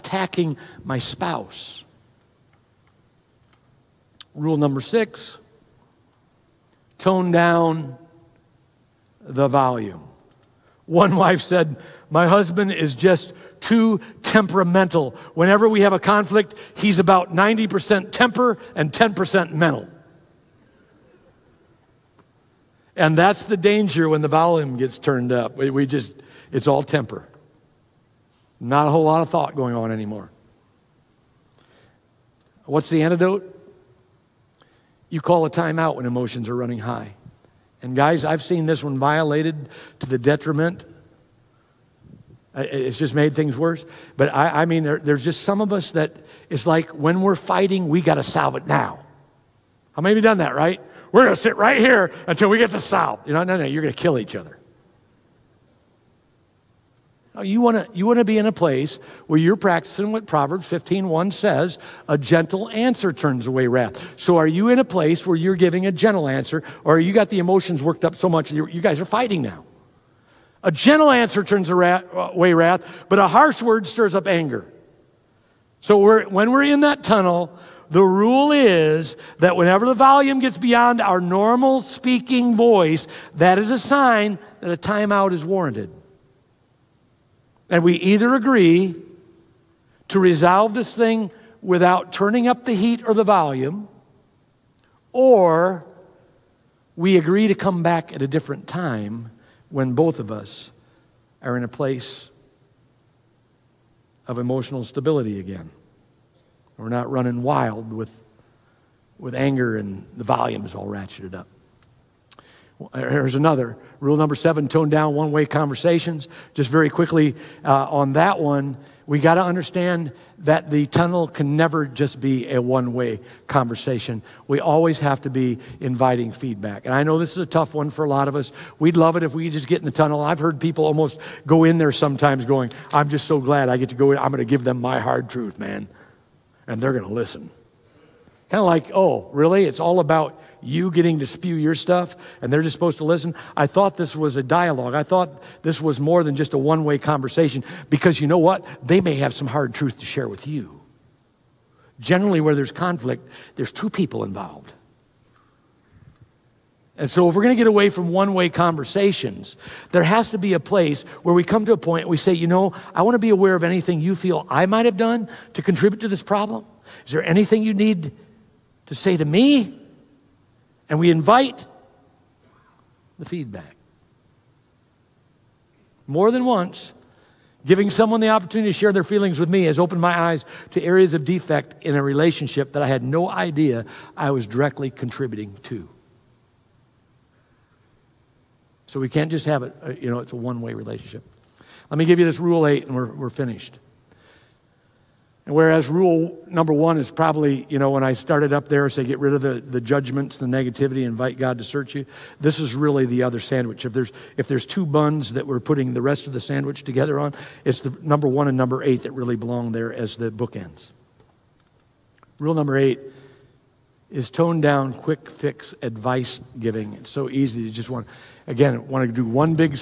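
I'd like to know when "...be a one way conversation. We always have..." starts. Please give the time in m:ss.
2:02.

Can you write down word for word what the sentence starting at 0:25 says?
We, we just, it's all temper.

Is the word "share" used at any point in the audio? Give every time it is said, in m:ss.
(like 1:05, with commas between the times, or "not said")
2:30, 2:58.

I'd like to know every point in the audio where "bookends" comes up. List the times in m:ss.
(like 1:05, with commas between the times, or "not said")
3:30.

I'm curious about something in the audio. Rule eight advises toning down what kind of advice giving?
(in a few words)
Quick fix.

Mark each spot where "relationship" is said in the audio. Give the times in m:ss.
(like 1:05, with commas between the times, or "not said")
3:02, 3:10.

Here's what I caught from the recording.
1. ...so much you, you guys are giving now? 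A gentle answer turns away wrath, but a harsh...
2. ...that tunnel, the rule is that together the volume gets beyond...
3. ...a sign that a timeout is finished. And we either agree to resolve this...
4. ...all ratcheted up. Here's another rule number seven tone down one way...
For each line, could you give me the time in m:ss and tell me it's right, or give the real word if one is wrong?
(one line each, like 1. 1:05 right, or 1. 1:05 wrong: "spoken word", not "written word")
1. 1:08 wrong: "fighting", not "giving"
2. 1:16 wrong: "whenever", not "together"
3. 1:23 wrong: "warranted", not "finished"
4. 1:50 right.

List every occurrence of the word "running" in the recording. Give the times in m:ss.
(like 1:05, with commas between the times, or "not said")
0:36, 1:47.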